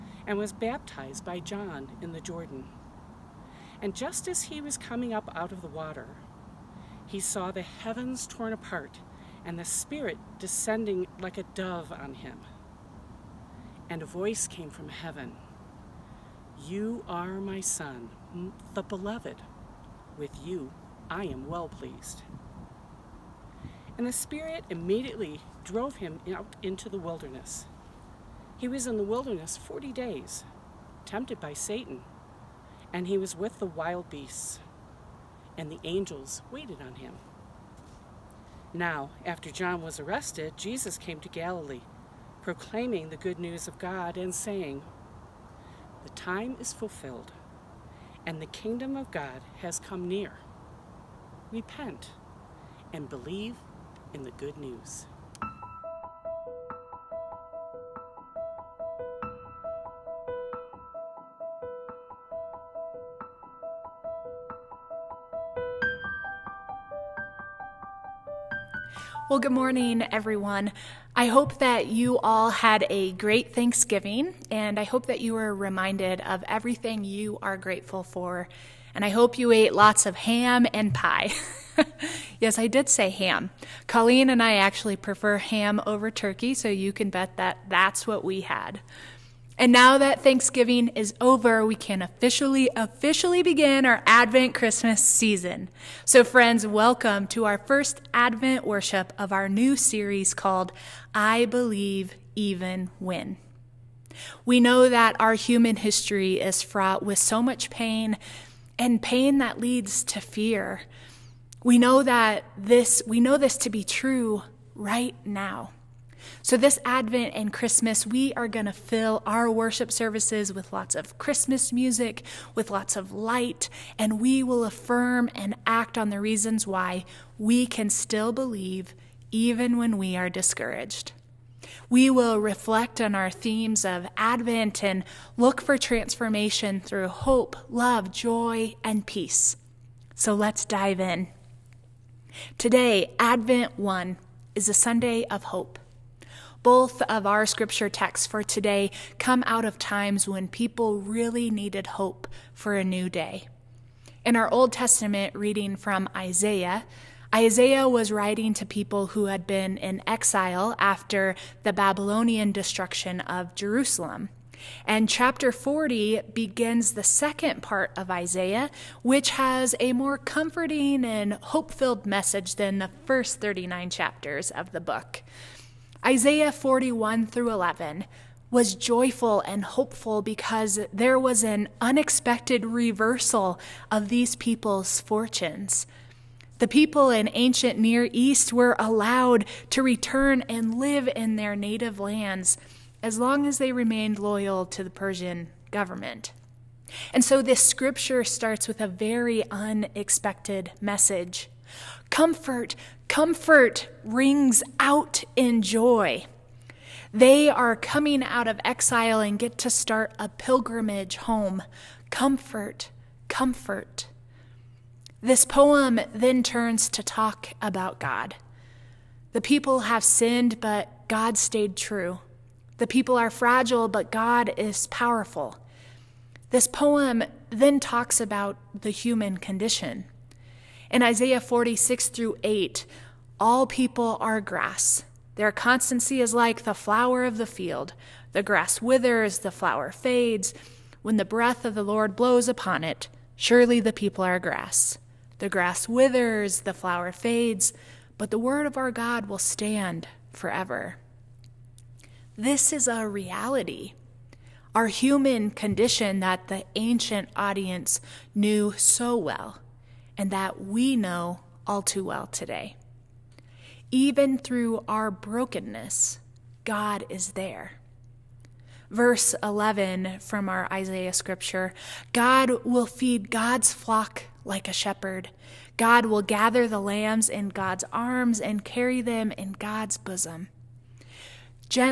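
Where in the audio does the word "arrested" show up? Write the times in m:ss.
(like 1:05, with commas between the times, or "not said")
0:39.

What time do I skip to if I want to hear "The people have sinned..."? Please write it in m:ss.
3:39.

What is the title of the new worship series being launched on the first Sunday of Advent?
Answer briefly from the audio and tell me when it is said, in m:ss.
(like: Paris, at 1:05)
I Believe Even When, at 1:41.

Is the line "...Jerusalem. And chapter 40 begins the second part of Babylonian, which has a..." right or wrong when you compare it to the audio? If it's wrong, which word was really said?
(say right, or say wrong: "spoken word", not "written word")
wrong: "Isaiah", not "Babylonian".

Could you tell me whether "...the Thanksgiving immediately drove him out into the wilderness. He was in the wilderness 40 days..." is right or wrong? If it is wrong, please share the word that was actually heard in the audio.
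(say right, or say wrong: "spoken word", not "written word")
wrong: "Spirit", not "Thanksgiving".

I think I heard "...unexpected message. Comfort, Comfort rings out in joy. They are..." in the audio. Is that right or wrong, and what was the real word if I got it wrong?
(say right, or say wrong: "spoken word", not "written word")
right.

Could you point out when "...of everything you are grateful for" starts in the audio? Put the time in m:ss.
1:16.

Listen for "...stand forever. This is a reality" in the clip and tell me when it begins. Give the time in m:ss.
4:09.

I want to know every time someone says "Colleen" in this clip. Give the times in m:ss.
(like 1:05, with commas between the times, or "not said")
1:23.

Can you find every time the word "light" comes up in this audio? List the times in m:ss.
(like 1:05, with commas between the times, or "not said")
2:03.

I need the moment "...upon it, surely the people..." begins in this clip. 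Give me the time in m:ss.
4:02.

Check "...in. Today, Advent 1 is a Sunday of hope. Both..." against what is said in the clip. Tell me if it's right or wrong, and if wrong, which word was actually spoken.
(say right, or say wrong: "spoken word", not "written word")
right.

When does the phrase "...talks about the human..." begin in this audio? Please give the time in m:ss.
3:47.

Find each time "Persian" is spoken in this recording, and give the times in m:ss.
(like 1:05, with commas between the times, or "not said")
3:14.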